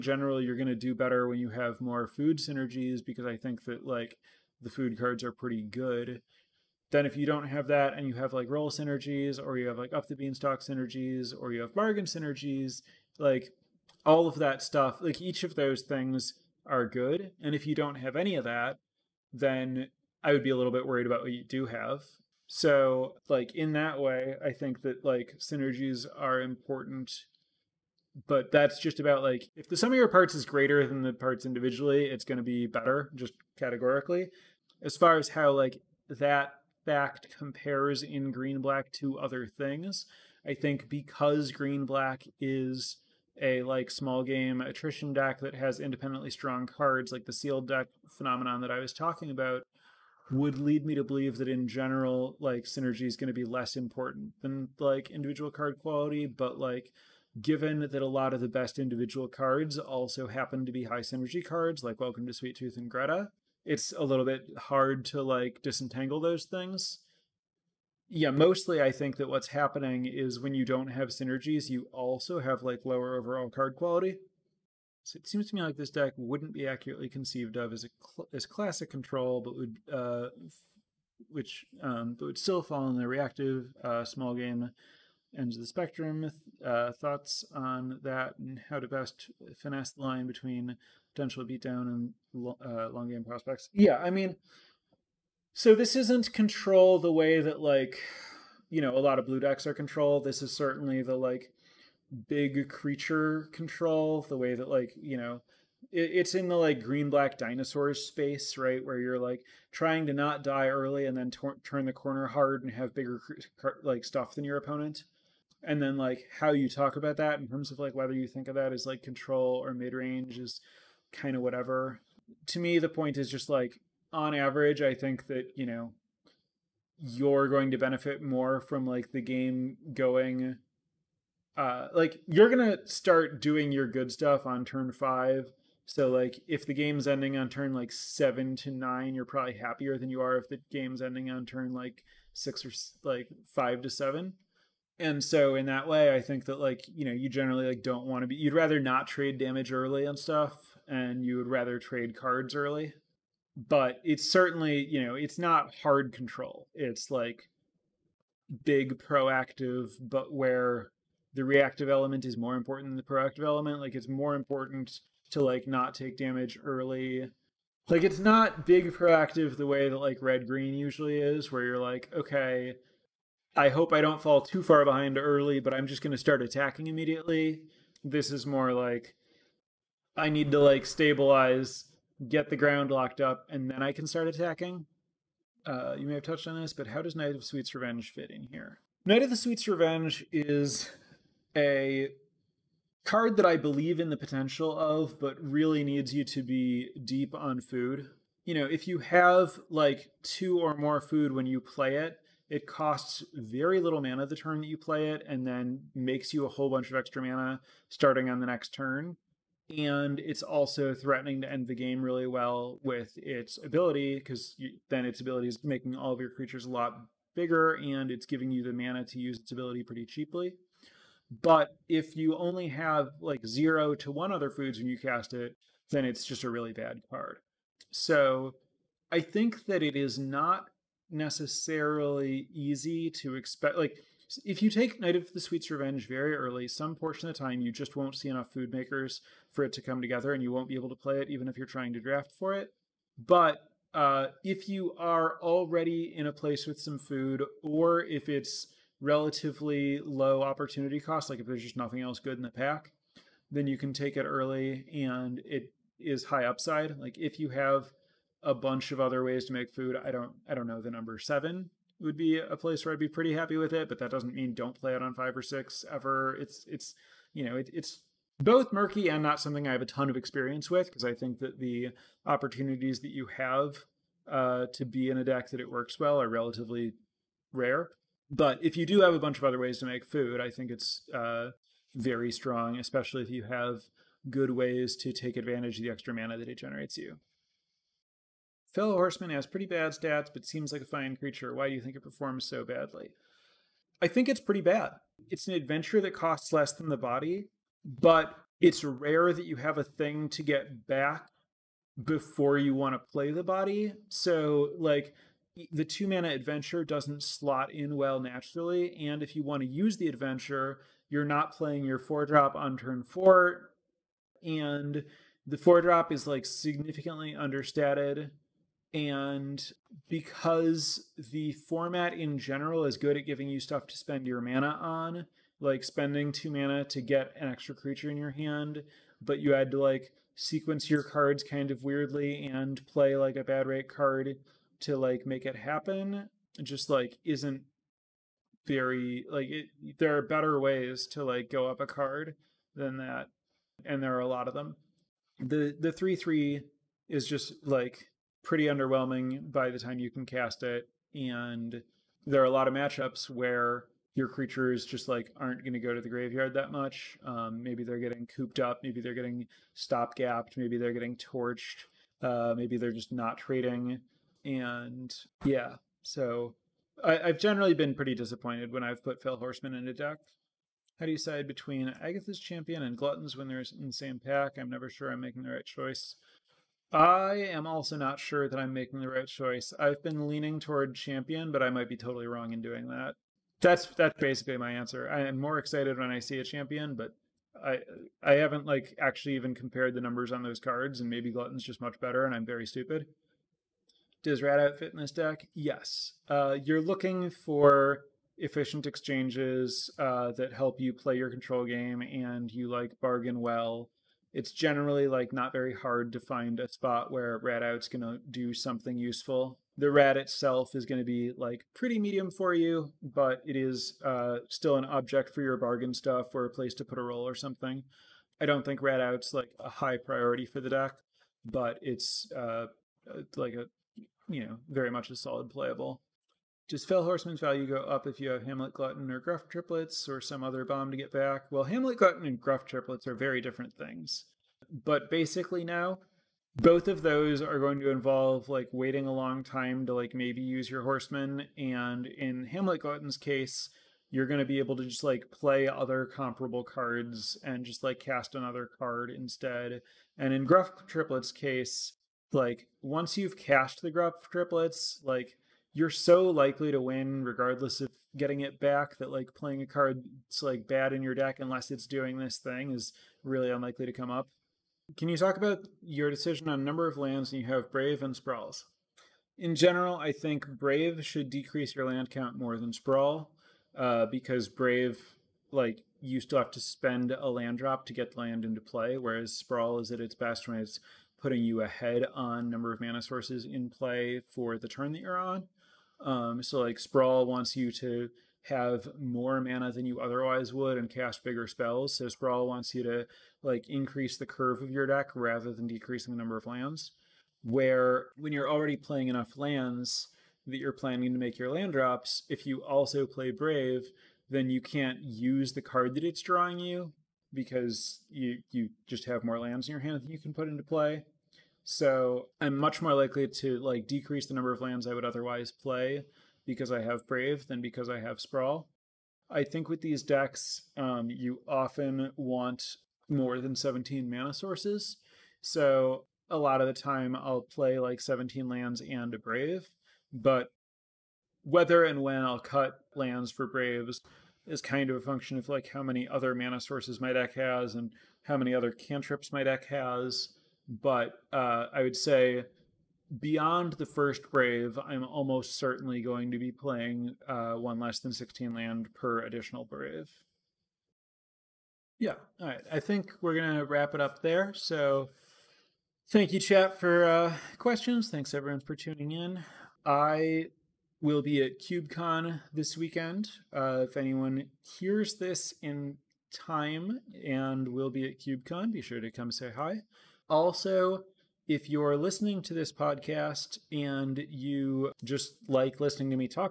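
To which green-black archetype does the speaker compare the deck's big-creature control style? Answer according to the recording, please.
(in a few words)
Dinosaurs.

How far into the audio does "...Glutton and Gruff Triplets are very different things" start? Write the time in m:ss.
7:11.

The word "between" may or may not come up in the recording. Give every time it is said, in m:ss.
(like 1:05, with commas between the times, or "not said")
1:30, 6:11.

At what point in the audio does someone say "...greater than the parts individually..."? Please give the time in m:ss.
0:30.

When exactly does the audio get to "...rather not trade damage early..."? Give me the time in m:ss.
2:28.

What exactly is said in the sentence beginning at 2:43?
Like it's more important to like not take damage early.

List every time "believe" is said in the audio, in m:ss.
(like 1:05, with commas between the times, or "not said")
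0:51, 3:13.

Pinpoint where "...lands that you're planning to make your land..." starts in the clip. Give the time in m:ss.
8:19.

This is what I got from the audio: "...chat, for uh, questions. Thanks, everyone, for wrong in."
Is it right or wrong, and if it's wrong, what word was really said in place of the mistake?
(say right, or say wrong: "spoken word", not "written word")
wrong: "tuning", not "wrong".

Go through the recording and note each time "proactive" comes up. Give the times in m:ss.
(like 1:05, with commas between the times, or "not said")
2:39, 2:43, 2:48.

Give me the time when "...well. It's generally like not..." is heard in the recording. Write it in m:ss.
6:43.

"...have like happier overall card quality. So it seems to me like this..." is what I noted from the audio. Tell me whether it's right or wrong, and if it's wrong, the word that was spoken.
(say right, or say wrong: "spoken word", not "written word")
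wrong: "lower", not "happier".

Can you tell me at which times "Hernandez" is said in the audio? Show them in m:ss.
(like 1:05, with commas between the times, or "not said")
not said.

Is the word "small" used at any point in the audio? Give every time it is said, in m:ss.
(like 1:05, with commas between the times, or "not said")
0:43, 1:24.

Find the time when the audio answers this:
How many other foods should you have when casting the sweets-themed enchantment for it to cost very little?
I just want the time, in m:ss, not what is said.
3:20.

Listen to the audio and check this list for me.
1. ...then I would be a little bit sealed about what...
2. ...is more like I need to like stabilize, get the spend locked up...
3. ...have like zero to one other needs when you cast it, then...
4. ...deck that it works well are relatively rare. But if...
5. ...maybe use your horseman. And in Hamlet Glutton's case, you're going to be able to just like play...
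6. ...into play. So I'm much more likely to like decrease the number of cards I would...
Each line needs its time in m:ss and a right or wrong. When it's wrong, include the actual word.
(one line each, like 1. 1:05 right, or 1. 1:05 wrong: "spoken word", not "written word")
1. 0:19 wrong: "worried", not "sealed"
2. 2:58 wrong: "ground", not "spend"
3. 3:42 wrong: "foods", not "needs"
4. 4:35 right
5. 7:20 right
6. 8:30 wrong: "lands", not "cards".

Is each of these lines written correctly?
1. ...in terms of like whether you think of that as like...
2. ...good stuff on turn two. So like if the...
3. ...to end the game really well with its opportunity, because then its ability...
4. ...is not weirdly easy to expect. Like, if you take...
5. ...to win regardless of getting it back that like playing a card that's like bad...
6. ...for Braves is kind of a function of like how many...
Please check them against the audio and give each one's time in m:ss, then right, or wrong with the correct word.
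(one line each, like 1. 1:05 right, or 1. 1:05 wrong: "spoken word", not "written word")
1. 1:57 right
2. 2:13 wrong: "five", not "two"
3. 3:31 wrong: "ability", not "opportunity"
4. 3:49 wrong: "necessarily", not "weirdly"
5. 7:36 right
6. 8:53 right.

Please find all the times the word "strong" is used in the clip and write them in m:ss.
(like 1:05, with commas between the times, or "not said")
0:46, 4:42.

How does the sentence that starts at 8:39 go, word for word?
I think with these decks, um, you often want more than 17 mana sources.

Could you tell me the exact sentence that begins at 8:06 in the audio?
Um, so like Sprawl wants you to have more mana than you otherwise would and cast bigger spells.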